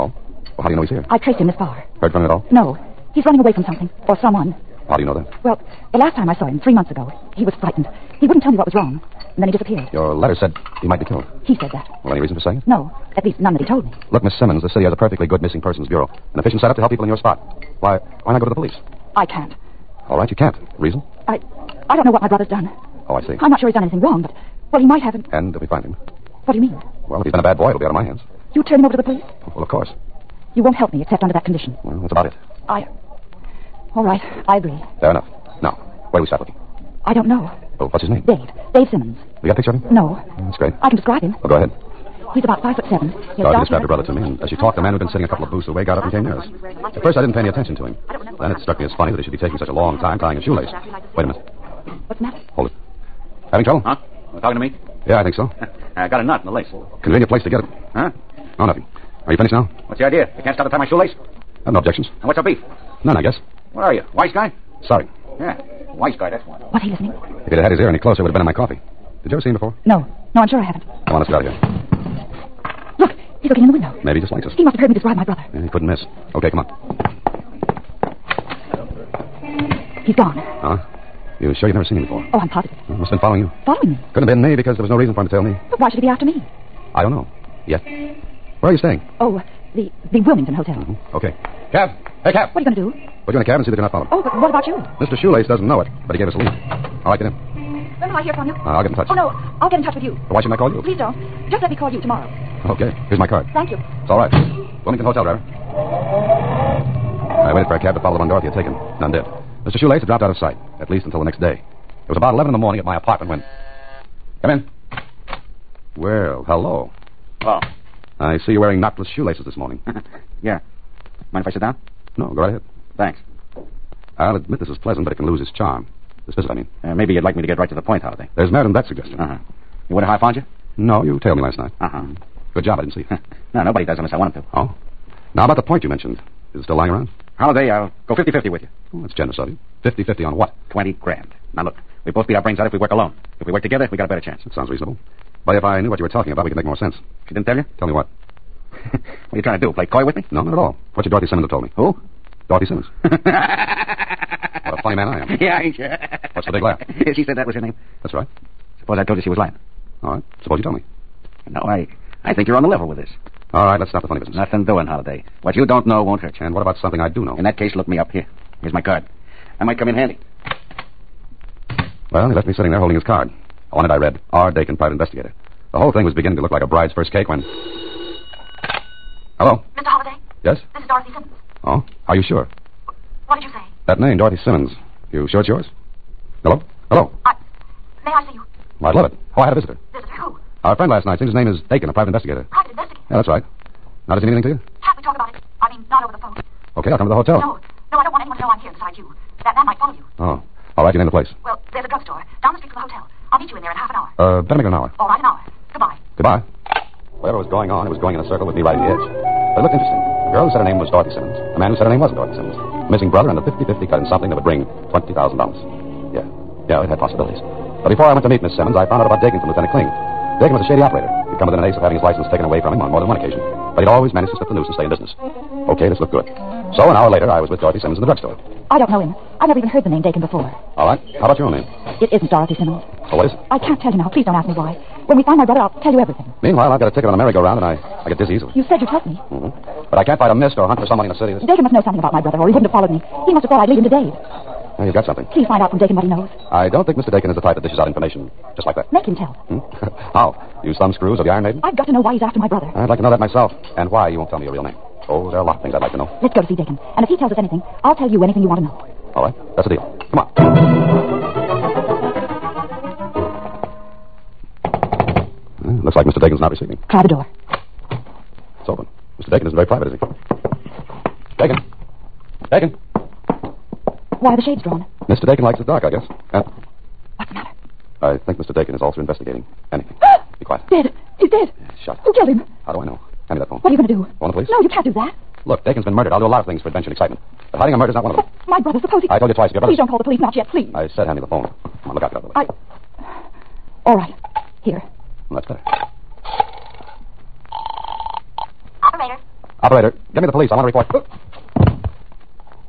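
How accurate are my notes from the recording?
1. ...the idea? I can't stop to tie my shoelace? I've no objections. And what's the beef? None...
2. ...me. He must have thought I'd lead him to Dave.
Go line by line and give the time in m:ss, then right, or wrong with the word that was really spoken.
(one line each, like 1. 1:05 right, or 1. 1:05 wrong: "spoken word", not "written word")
1. 0:59 right
2. 4:02 right.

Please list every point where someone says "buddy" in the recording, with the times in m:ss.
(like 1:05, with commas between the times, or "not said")
not said.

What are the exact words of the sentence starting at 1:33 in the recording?
Put you in a cab and see that you're not followed.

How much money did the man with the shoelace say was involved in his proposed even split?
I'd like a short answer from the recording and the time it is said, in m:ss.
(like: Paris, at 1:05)
20 grand, at 2:20.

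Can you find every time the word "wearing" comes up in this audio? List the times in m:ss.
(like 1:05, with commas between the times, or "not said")
1:58.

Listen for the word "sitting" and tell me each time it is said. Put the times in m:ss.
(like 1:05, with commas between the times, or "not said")
0:45, 2:52.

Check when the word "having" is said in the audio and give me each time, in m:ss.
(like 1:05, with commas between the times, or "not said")
0:53, 3:41.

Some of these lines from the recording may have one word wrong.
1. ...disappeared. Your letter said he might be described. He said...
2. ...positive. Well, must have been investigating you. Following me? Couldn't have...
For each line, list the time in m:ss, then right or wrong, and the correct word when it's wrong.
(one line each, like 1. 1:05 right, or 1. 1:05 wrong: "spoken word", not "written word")
1. 0:09 wrong: "killed", not "described"
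2. 1:22 wrong: "following", not "investigating".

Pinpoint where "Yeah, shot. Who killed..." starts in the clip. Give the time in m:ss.
4:41.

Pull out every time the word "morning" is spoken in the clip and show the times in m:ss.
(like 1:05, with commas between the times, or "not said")
1:52, 1:59.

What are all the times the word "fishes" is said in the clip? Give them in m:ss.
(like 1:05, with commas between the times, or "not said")
not said.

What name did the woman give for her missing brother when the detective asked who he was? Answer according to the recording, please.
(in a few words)
Dave Simmons.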